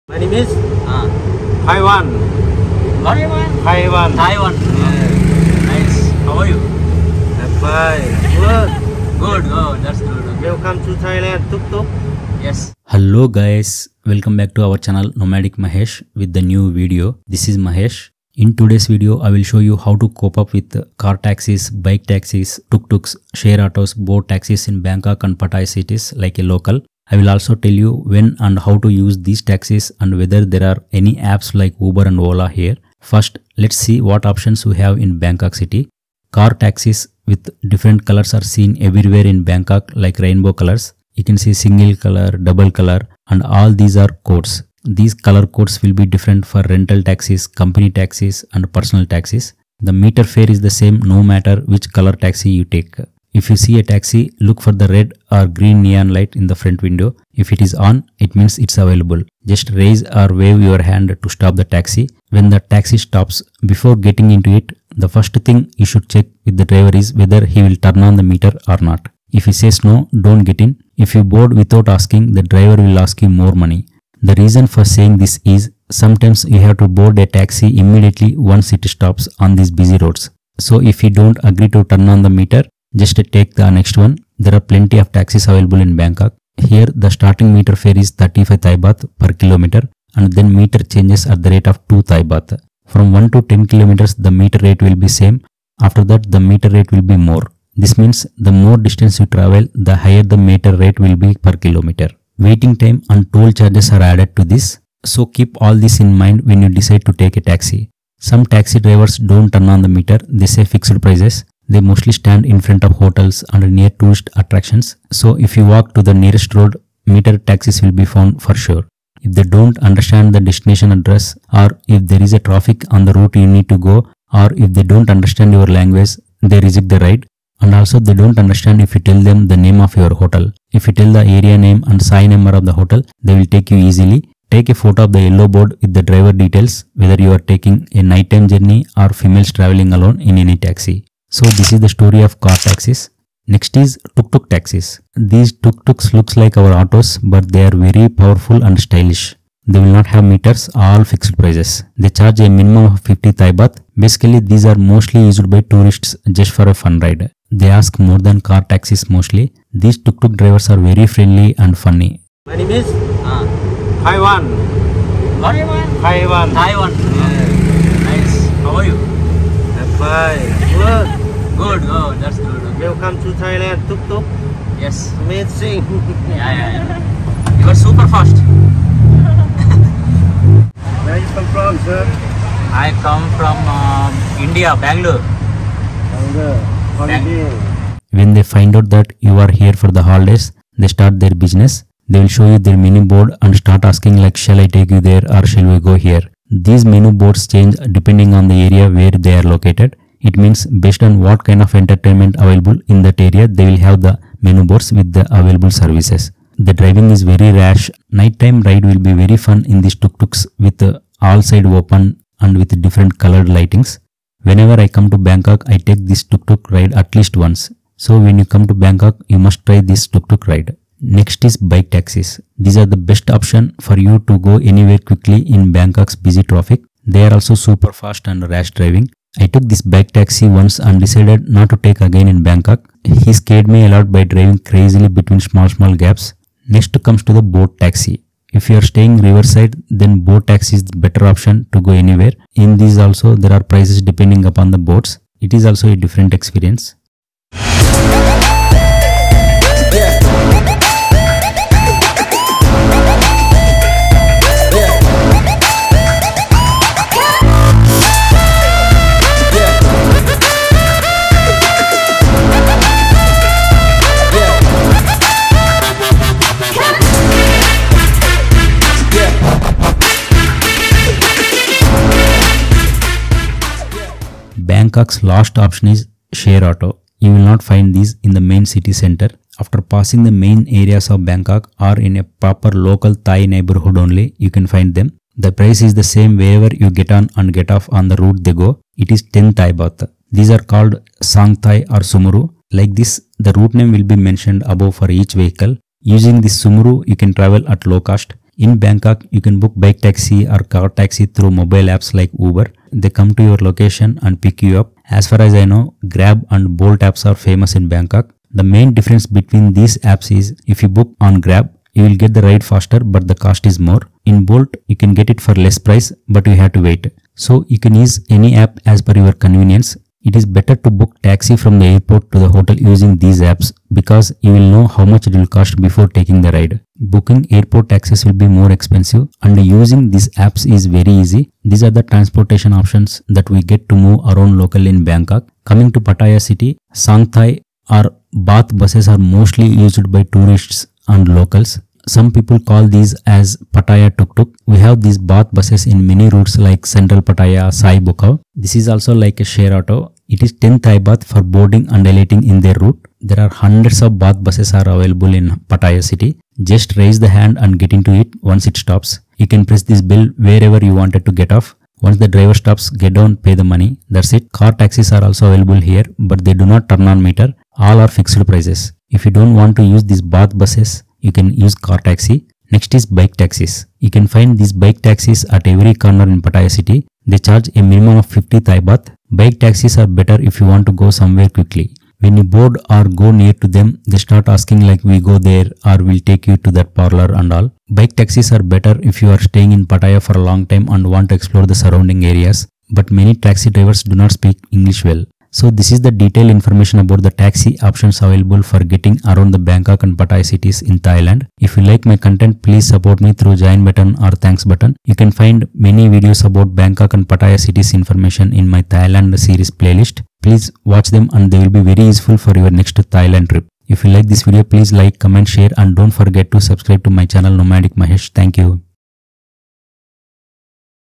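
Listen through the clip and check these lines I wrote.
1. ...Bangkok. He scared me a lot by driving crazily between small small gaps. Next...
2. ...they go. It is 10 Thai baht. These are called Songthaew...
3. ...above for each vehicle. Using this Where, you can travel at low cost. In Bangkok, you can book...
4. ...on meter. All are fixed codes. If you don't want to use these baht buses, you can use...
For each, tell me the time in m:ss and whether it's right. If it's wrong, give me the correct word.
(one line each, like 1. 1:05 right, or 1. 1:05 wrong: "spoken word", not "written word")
1. 3:52 right
2. 4:48 right
3. 4:54 wrong: "Sumuru", not "Where"
4. 6:07 wrong: "prices", not "codes".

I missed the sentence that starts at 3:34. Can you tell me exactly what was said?
Whenever I come to Bangkok, I take this tuk-tuk ride at least once.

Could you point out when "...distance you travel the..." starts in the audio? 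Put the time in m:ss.
1:38.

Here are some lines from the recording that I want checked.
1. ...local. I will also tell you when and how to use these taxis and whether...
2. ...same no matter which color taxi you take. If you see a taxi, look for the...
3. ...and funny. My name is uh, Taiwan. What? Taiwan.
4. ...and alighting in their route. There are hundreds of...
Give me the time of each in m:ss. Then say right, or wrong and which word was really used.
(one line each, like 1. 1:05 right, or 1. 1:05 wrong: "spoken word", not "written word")
1. 0:26 right
2. 0:50 right
3. 2:41 right
4. 5:51 right.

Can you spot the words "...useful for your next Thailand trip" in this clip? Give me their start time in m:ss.
6:52.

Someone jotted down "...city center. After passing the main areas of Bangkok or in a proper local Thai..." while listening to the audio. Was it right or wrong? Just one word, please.
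right.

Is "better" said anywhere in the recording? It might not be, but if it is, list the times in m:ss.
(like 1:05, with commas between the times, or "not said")
4:00, 5:20, 6:20, 6:28.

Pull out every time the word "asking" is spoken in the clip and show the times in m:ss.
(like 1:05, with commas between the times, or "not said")
1:11, 3:13, 6:24.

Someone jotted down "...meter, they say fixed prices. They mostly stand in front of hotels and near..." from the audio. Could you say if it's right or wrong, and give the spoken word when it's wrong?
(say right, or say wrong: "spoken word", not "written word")
right.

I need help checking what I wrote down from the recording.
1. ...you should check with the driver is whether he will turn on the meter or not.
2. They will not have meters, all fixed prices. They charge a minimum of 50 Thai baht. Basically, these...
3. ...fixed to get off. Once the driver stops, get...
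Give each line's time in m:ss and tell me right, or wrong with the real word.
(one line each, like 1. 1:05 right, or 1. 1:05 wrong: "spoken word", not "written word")
1. 1:05 right
2. 2:29 right
3. 6:00 wrong: "wanted", not "fixed".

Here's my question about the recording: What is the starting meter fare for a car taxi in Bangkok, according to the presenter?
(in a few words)
35 Thai baht.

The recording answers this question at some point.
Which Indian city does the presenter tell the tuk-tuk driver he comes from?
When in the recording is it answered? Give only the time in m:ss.
3:04.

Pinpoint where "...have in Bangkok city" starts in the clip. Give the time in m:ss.
0:34.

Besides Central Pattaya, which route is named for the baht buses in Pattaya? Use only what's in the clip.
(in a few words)
Soi Buakhao.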